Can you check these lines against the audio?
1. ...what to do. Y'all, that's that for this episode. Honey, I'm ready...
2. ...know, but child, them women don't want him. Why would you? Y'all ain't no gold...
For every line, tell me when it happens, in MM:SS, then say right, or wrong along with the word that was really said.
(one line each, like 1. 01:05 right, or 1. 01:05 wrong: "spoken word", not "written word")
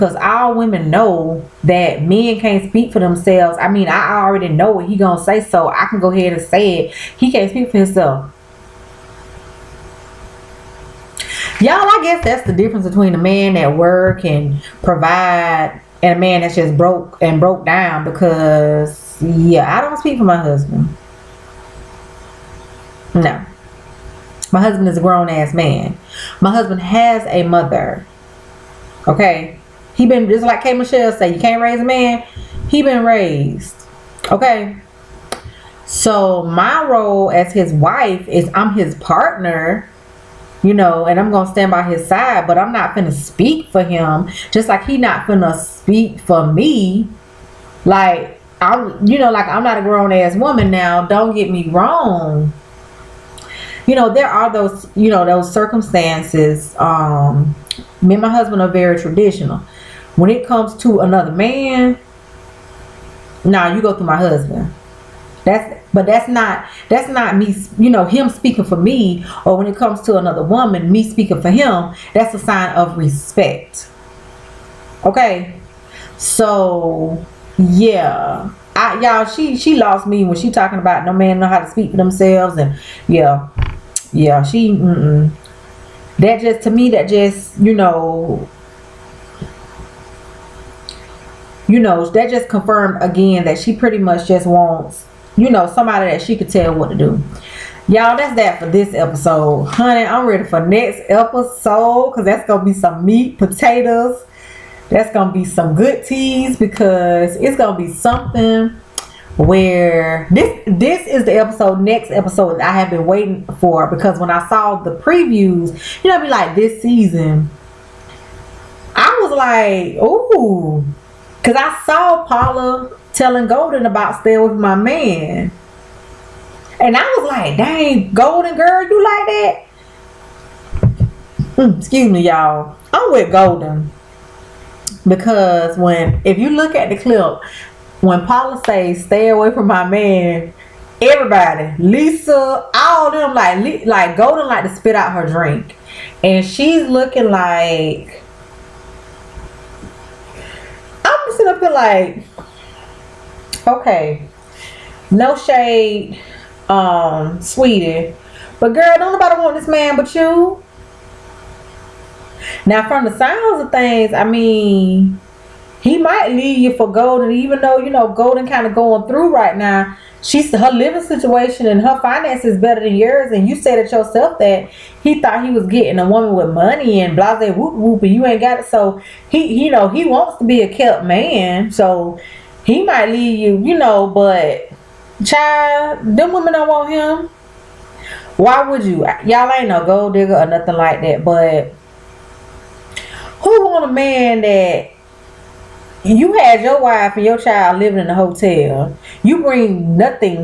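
1. 01:36 right
2. 03:03 right.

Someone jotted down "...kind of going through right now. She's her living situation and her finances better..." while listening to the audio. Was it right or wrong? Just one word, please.
right.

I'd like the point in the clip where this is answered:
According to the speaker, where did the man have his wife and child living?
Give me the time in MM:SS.
03:18.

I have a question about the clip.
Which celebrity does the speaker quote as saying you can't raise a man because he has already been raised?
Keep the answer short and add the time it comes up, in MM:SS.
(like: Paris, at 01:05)
K Michelle, at 00:30.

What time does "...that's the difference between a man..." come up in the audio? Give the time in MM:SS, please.
00:12.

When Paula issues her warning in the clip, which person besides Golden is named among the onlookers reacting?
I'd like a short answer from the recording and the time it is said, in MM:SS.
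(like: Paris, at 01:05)
Lisa, at 02:21.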